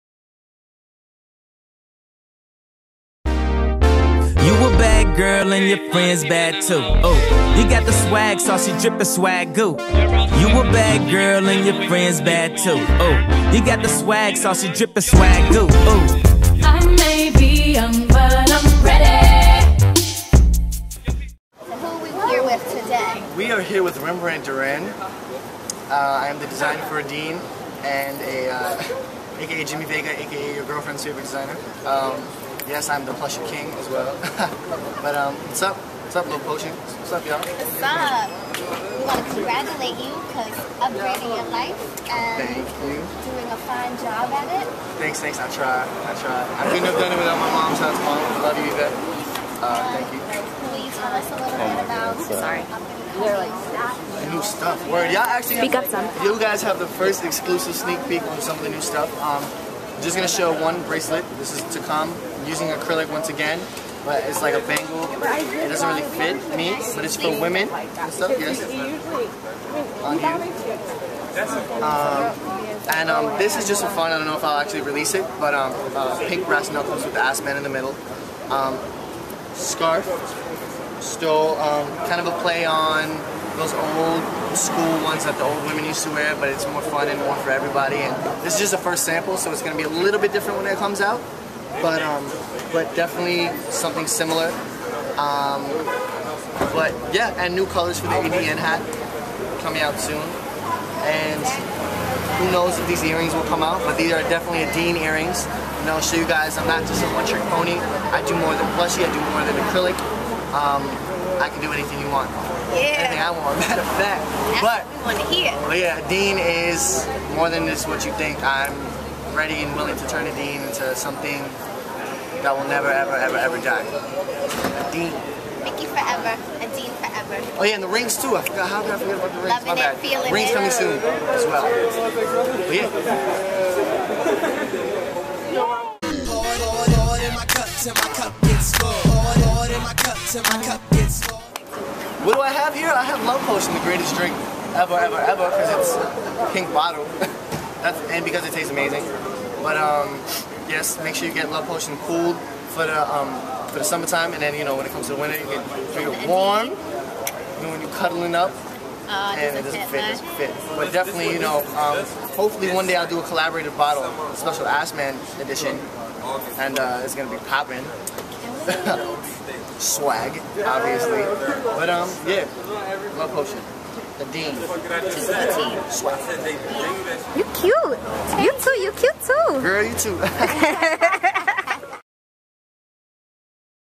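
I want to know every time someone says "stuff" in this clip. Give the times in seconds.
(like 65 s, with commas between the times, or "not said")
54 s, 58 s, 68 s.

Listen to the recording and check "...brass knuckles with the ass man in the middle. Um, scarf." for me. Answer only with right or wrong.
right.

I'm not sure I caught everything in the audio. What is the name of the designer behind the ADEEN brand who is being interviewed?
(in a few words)
Rembrandt Duran.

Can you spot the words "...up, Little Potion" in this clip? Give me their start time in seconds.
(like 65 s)
36 s.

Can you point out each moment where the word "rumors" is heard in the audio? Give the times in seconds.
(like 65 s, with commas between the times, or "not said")
not said.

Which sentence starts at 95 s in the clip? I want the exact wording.
Um, but yeah, and new colors for the ADEEN hat coming out soon.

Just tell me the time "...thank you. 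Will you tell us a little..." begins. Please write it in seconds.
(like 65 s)
49 s.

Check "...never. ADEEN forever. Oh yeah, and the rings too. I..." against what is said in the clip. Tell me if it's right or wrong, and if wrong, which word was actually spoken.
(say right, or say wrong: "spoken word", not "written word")
wrong: "forever", not "never".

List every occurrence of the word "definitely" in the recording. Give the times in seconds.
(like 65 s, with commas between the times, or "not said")
92 s, 104 s, 160 s.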